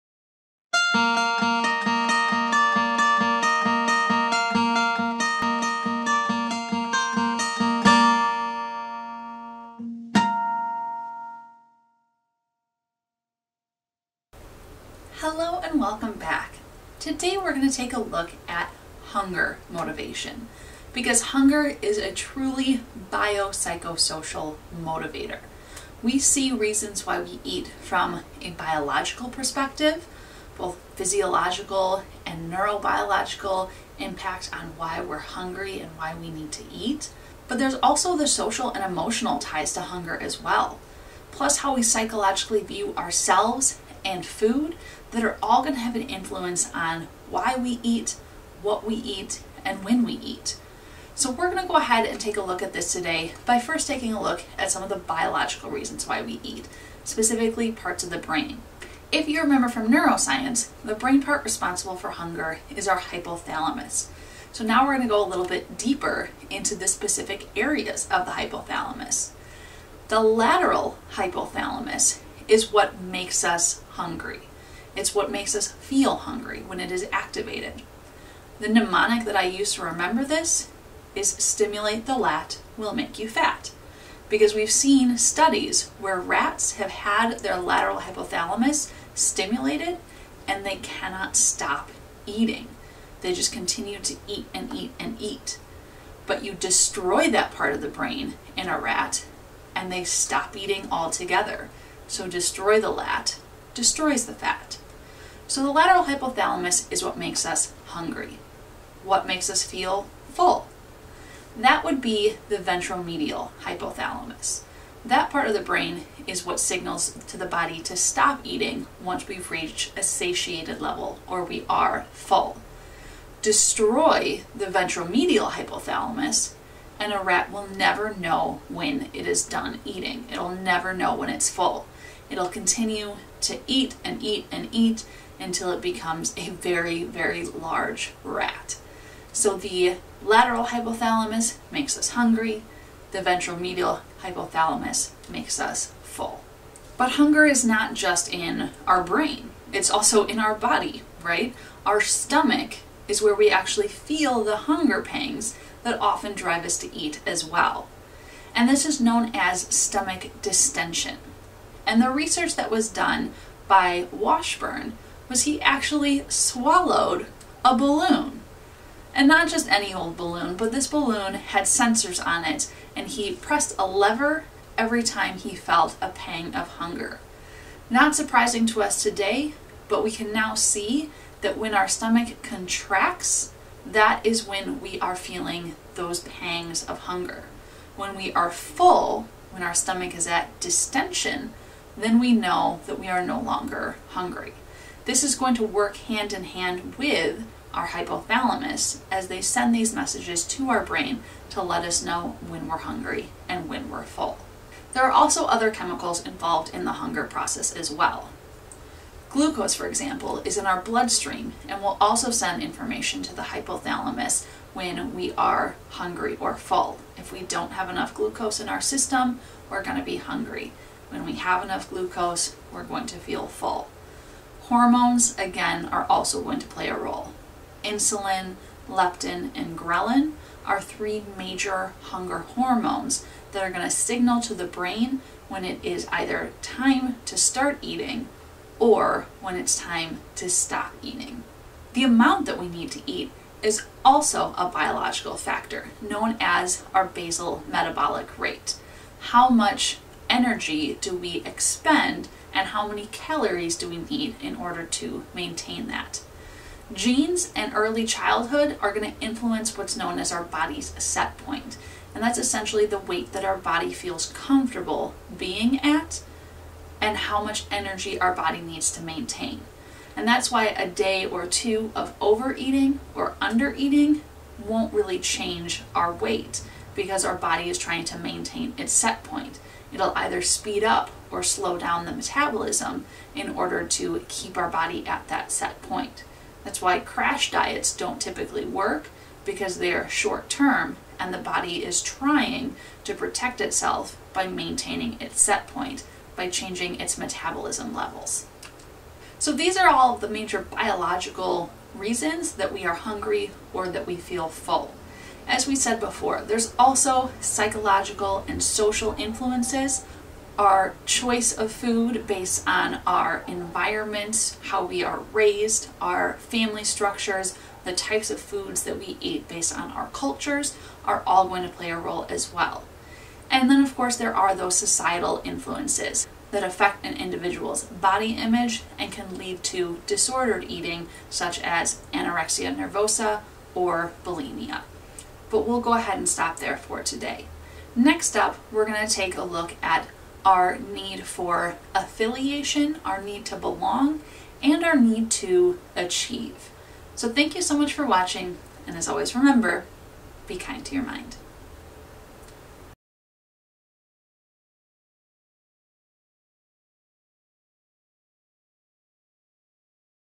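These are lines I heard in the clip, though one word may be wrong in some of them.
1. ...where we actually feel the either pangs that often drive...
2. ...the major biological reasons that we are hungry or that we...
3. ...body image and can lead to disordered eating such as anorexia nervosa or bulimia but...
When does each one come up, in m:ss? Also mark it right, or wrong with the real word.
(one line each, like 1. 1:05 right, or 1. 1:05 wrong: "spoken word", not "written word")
1. 2:33 wrong: "hunger", not "either"
2. 5:00 right
3. 5:27 right.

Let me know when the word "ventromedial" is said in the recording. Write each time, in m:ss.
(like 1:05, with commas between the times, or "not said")
1:52, 2:04, 2:23.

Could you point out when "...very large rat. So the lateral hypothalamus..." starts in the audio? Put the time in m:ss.
2:17.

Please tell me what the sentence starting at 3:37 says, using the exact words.
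If we don't have enough glucose in our system, we're going to be hungry.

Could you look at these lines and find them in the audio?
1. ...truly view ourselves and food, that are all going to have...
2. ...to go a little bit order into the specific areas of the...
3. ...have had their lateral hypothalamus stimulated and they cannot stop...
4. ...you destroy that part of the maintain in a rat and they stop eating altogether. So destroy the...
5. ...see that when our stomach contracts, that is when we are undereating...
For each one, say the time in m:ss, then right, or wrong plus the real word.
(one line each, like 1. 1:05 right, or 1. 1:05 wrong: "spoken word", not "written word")
1. 0:41 wrong: "psychologically", not "truly"
2. 1:05 wrong: "deeper", not "order"
3. 1:26 right
4. 1:36 wrong: "brain", not "maintain"
5. 3:00 wrong: "feeling", not "undereating".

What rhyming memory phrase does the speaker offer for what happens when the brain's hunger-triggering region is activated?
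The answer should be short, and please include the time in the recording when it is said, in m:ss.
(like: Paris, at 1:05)
Stimulate the lat will make you fat, at 1:21.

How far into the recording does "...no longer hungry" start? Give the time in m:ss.
3:13.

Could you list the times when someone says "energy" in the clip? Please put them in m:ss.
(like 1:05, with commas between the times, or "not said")
4:10, 4:27.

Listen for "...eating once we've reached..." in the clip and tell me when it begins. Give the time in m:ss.
1:58.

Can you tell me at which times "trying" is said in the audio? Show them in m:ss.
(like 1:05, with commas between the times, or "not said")
4:37, 4:52.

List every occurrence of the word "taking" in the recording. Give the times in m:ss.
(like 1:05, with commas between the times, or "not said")
0:53.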